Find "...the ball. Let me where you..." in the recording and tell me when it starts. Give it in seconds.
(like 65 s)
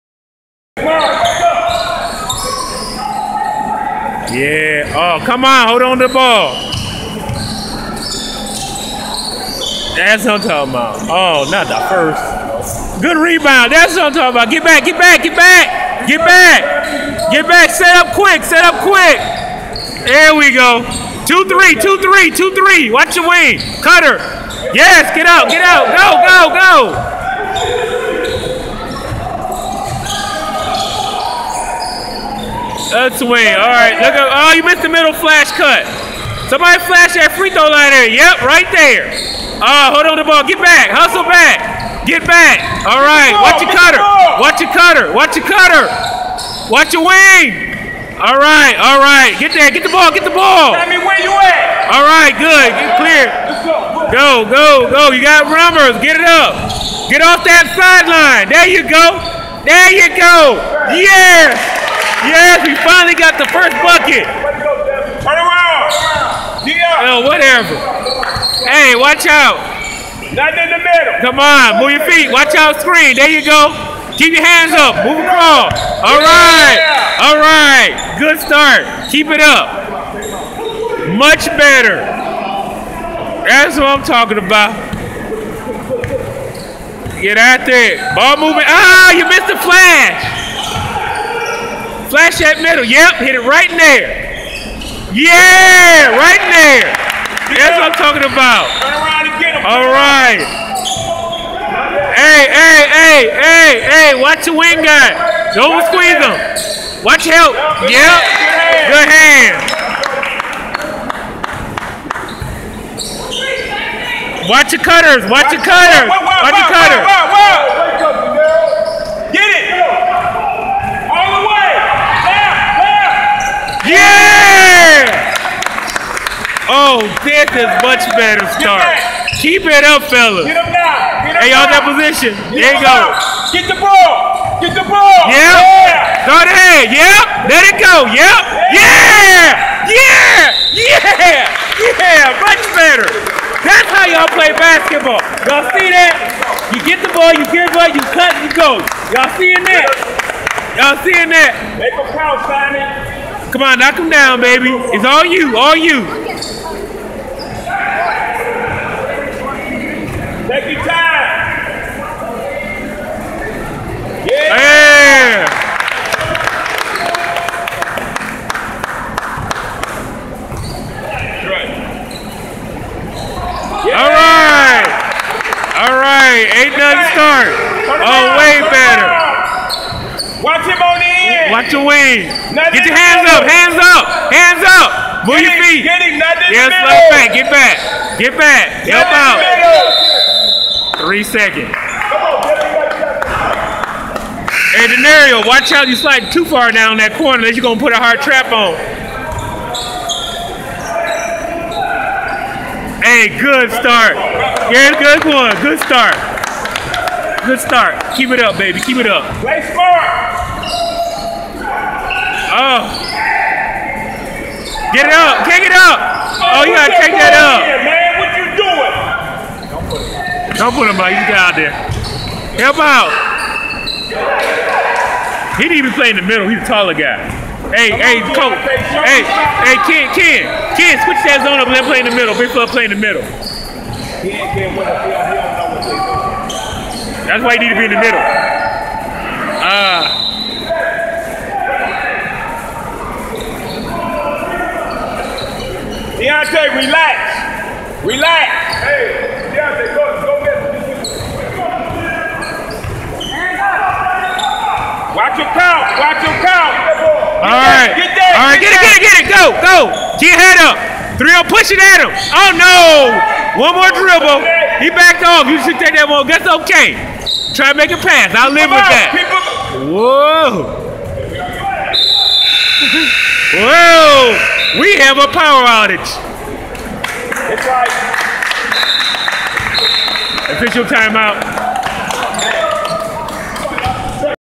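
50 s.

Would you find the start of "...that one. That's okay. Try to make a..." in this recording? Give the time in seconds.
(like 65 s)
265 s.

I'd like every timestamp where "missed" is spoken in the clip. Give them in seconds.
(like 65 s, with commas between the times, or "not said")
34 s, 89 s.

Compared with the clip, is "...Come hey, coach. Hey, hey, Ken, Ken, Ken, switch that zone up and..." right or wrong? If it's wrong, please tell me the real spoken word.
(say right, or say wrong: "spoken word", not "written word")
right.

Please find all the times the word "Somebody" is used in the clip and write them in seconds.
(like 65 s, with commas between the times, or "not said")
36 s.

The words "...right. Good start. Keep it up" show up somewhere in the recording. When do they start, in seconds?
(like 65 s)
77 s.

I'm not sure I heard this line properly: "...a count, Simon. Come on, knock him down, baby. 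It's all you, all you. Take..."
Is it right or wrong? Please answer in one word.
right.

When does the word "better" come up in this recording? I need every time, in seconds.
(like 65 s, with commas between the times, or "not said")
81 s, 128 s, 142 s, 178 s.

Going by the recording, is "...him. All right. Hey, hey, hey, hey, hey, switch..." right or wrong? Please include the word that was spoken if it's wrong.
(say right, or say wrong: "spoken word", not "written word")
wrong: "watch", not "switch".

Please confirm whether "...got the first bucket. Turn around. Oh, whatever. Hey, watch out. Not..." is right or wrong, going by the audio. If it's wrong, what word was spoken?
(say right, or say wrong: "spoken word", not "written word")
right.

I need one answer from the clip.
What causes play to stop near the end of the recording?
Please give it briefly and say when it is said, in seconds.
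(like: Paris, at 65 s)
Power outage, at 275 s.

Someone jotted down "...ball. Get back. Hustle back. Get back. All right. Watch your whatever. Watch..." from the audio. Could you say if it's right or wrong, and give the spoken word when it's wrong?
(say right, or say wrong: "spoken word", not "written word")
wrong: "cutter", not "whatever".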